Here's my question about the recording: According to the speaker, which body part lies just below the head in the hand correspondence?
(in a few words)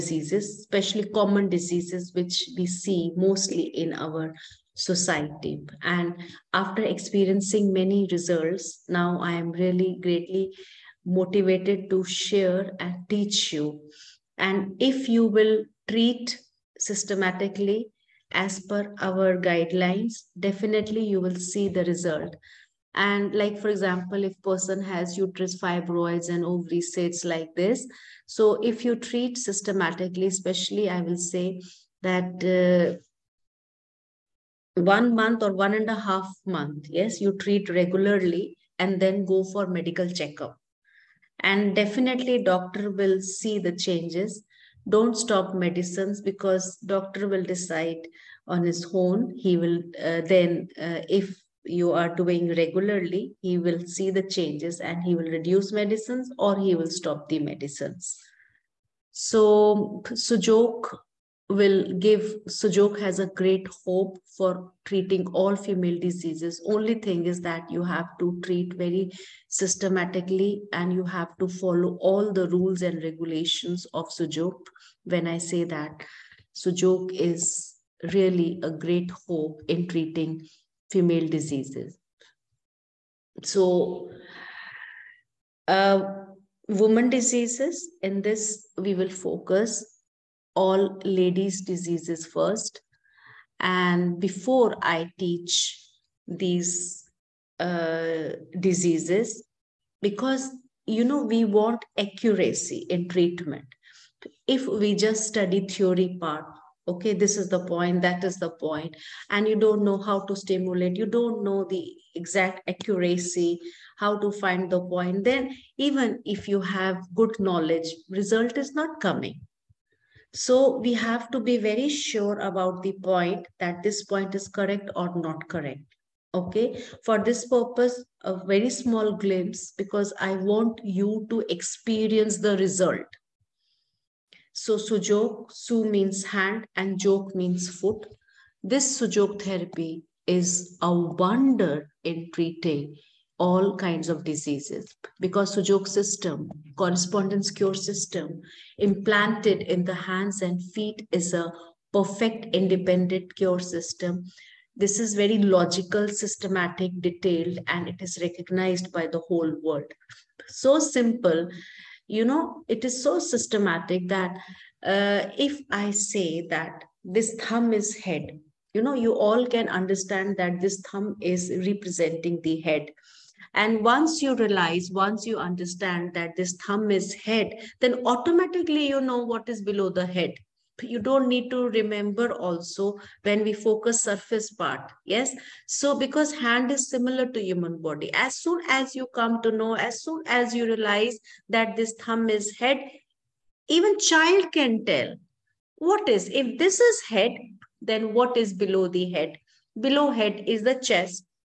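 chest.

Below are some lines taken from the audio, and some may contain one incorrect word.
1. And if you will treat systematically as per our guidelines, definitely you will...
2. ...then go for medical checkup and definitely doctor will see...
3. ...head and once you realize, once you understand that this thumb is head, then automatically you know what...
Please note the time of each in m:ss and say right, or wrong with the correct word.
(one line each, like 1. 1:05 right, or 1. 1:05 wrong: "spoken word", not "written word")
1. 0:14 right
2. 0:39 right
3. 2:52 right.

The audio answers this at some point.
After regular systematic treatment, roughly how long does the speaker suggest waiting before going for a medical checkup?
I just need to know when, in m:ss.
0:35.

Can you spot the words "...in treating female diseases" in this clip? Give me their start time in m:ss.
1:19.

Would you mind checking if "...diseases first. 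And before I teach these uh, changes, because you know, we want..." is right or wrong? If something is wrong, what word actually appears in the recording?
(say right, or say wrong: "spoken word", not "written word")
wrong: "diseases", not "changes".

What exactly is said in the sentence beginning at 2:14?
So sujok, su means hand and jok means foot.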